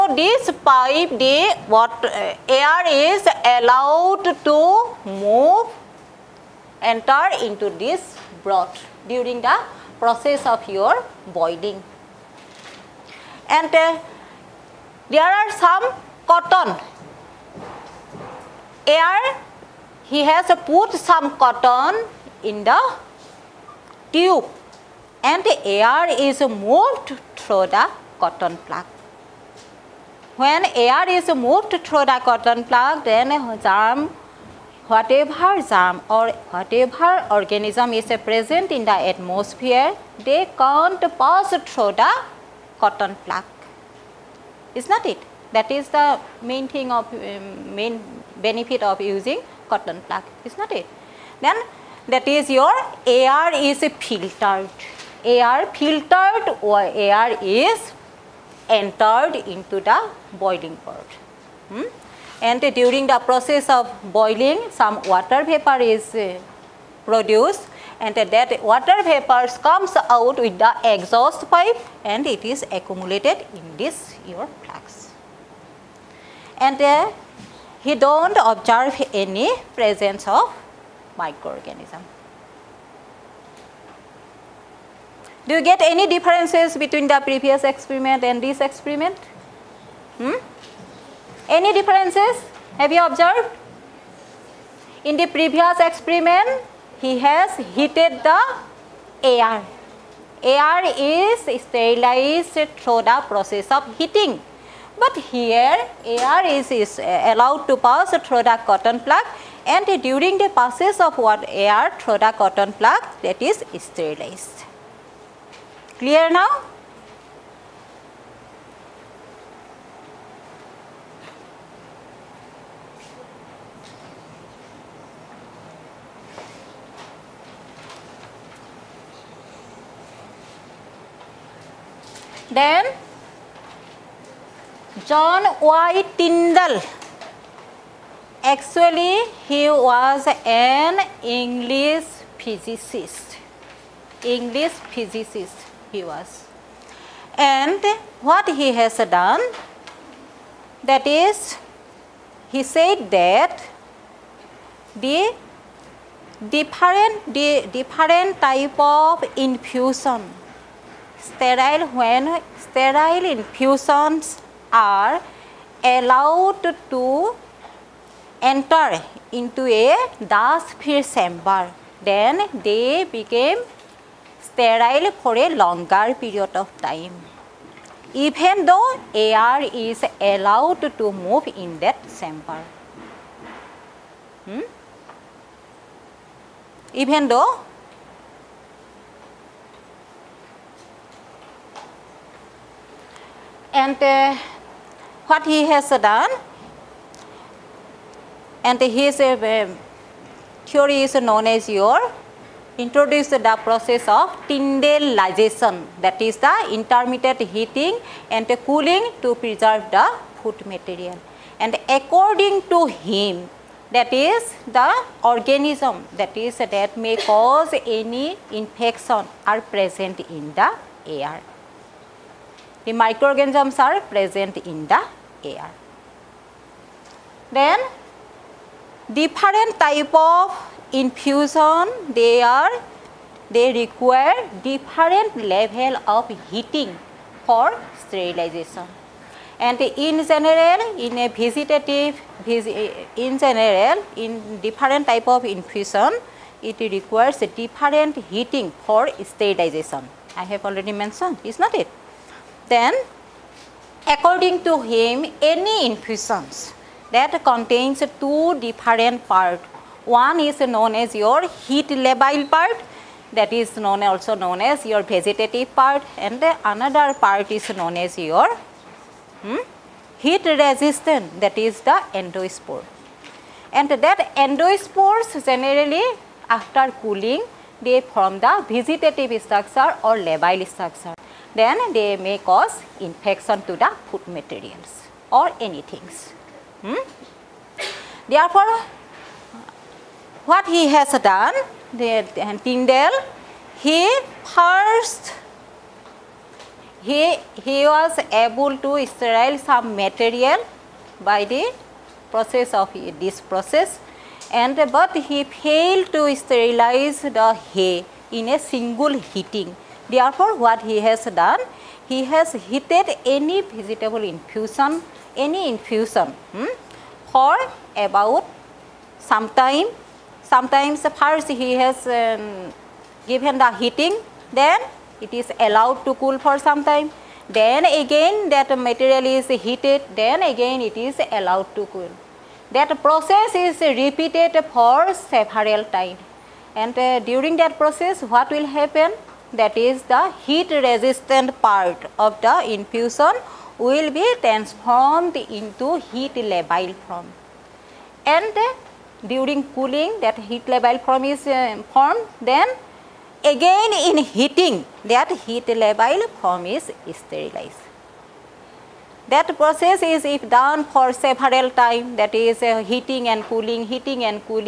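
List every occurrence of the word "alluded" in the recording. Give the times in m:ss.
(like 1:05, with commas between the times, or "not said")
not said.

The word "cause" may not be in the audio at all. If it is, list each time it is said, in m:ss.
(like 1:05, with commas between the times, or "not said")
3:37, 4:42.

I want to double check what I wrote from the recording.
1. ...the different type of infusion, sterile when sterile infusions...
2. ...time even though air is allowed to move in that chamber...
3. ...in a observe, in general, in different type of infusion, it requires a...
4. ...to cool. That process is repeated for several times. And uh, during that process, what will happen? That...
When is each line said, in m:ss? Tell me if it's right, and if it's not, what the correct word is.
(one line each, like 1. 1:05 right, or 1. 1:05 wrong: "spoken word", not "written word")
1. 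2:37 right
2. 2:56 right
3. 4:00 wrong: "vegetative", not "observe"
4. 5:31 right.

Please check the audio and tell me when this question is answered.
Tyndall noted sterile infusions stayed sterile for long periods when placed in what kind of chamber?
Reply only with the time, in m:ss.
2:50.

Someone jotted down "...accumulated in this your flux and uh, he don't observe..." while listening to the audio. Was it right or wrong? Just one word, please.
right.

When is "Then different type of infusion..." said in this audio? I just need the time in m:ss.
3:47.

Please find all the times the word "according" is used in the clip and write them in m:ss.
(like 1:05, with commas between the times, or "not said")
3:31, 4:14.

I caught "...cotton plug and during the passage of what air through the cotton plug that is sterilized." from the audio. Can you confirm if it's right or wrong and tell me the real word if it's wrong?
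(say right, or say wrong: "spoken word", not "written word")
right.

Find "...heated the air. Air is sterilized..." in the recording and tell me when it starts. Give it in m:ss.
1:37.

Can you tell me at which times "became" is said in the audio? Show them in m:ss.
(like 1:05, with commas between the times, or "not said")
2:53.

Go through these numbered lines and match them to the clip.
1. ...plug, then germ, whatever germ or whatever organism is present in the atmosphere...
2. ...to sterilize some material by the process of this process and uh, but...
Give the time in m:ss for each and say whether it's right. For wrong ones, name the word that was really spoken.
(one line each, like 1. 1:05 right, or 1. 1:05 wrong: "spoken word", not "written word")
1. 0:32 right
2. 4:58 right.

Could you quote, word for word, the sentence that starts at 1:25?
Do you get any differences between the previous experiment and this experiment?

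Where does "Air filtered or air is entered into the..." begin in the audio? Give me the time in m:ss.
0:55.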